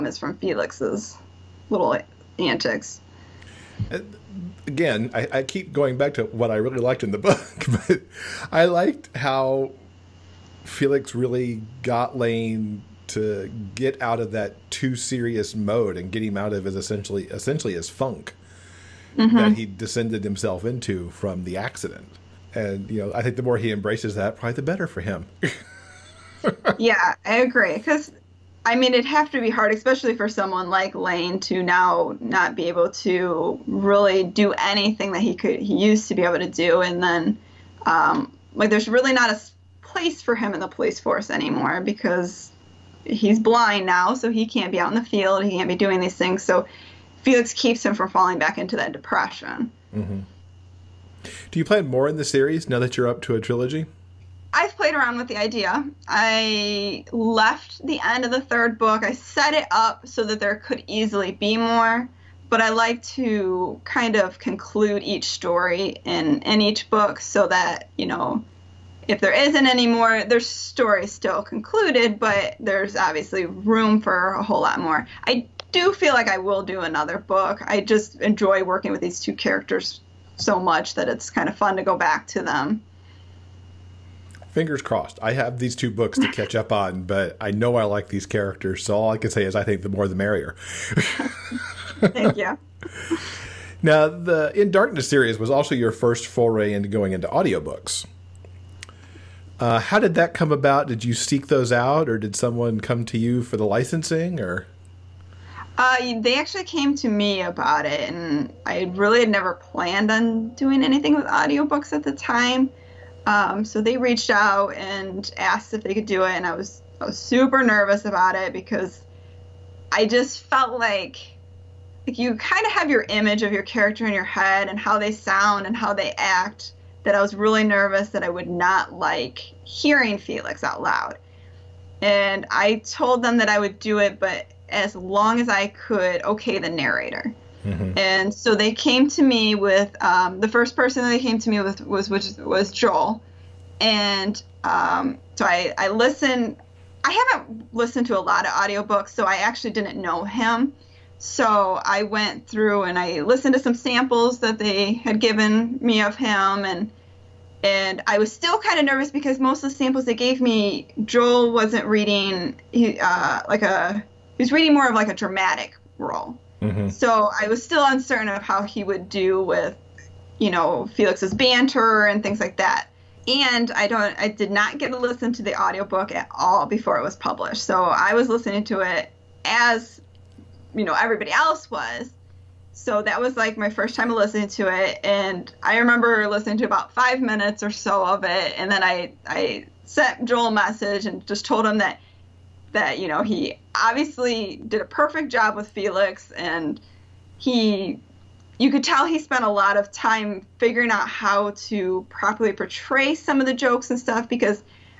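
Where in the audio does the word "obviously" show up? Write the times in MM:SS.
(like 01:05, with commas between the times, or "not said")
01:12, 03:13.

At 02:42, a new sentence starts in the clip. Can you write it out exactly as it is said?
He uh, like a he was reading more of like a dramatic role.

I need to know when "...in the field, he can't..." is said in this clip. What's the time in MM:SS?
00:44.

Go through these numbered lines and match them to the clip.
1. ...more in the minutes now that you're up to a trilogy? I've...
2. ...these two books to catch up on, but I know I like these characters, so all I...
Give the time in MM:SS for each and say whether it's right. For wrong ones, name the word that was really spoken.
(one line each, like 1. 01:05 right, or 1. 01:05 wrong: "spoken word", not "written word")
1. 00:51 wrong: "series", not "minutes"
2. 01:25 right.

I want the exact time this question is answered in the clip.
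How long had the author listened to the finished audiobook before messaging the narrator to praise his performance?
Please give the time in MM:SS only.
03:06.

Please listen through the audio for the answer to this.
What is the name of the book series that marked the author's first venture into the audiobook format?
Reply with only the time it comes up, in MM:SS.
01:34.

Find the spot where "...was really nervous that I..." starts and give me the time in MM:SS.
02:07.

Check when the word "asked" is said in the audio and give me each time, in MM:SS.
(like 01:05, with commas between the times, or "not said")
01:55.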